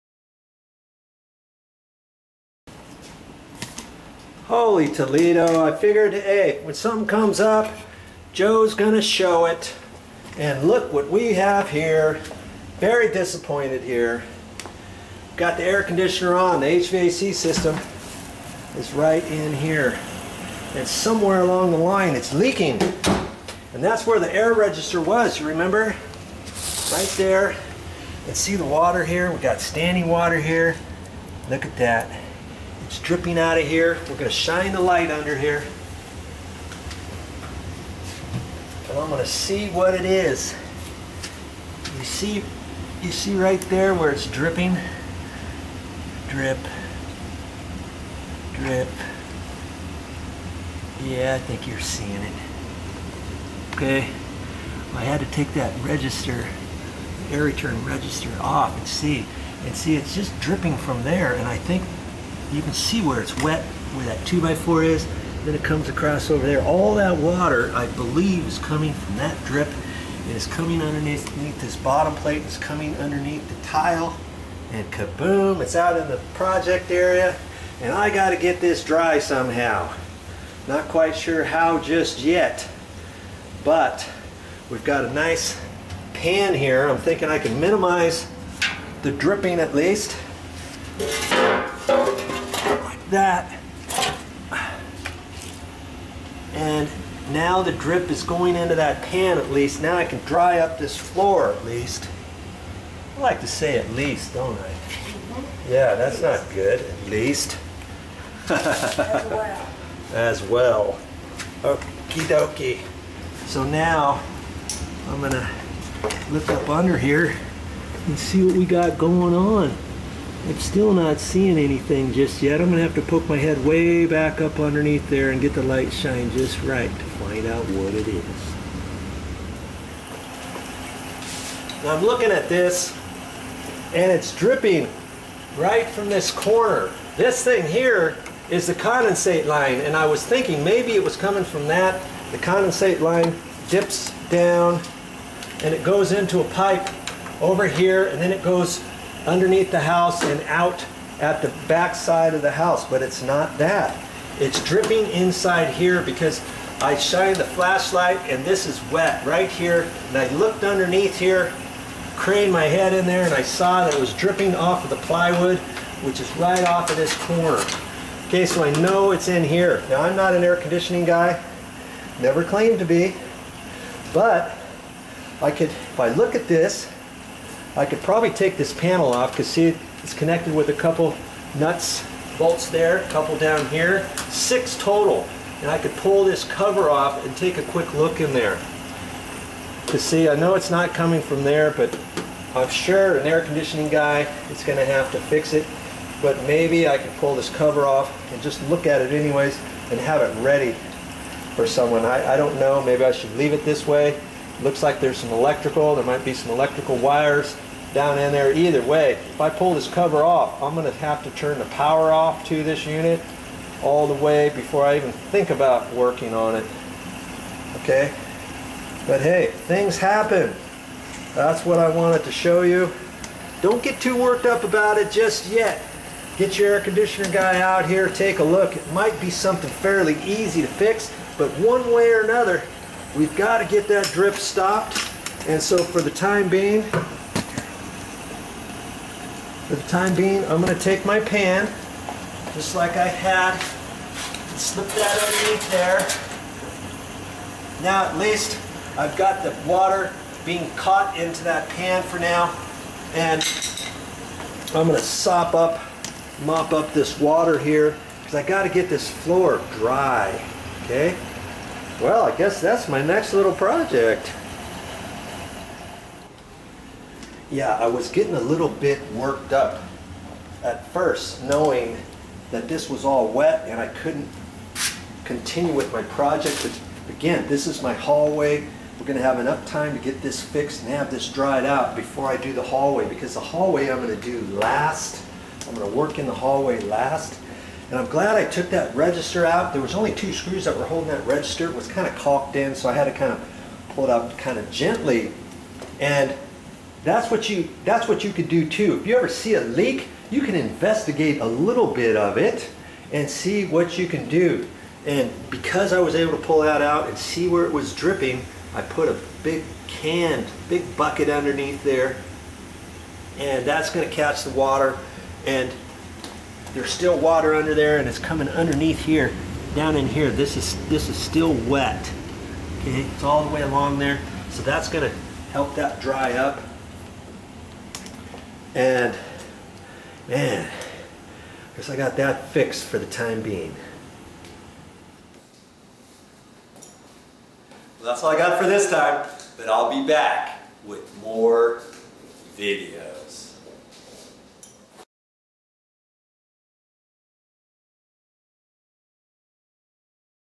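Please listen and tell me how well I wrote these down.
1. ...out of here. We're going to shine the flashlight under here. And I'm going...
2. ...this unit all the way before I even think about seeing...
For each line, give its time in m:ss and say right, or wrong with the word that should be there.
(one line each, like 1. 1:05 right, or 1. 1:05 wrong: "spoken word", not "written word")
1. 0:33 wrong: "light", not "flashlight"
2. 3:32 wrong: "working", not "seeing".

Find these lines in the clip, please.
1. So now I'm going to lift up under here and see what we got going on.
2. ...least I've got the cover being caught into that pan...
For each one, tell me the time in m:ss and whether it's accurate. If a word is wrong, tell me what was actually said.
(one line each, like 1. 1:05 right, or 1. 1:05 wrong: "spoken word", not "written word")
1. 1:53 right
2. 4:08 wrong: "water", not "cover".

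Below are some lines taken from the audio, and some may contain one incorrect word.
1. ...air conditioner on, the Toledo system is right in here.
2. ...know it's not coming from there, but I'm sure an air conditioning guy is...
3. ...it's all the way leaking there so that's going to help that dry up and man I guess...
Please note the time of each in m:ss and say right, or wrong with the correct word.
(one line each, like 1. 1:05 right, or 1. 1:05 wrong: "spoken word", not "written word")
1. 0:15 wrong: "HVAC", not "Toledo"
2. 3:10 right
3. 5:23 wrong: "along", not "leaking".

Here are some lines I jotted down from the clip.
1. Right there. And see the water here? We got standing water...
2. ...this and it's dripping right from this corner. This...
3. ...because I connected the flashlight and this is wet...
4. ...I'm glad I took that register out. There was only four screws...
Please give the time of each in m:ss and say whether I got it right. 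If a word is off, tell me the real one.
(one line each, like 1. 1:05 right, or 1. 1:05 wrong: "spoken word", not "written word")
1. 0:26 right
2. 2:12 right
3. 2:36 wrong: "shined", not "connected"
4. 4:47 wrong: "two", not "four".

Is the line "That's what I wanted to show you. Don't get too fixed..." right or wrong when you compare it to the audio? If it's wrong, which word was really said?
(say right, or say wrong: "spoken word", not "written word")
wrong: "worked", not "fixed".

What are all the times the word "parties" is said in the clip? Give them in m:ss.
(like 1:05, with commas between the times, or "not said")
not said.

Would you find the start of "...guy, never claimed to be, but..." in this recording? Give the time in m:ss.
2:51.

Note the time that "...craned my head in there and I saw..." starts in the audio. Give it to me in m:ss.
2:42.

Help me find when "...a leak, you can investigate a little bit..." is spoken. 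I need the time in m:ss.
4:59.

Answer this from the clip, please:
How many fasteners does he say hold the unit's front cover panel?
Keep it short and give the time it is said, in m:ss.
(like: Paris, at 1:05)
6, at 3:04.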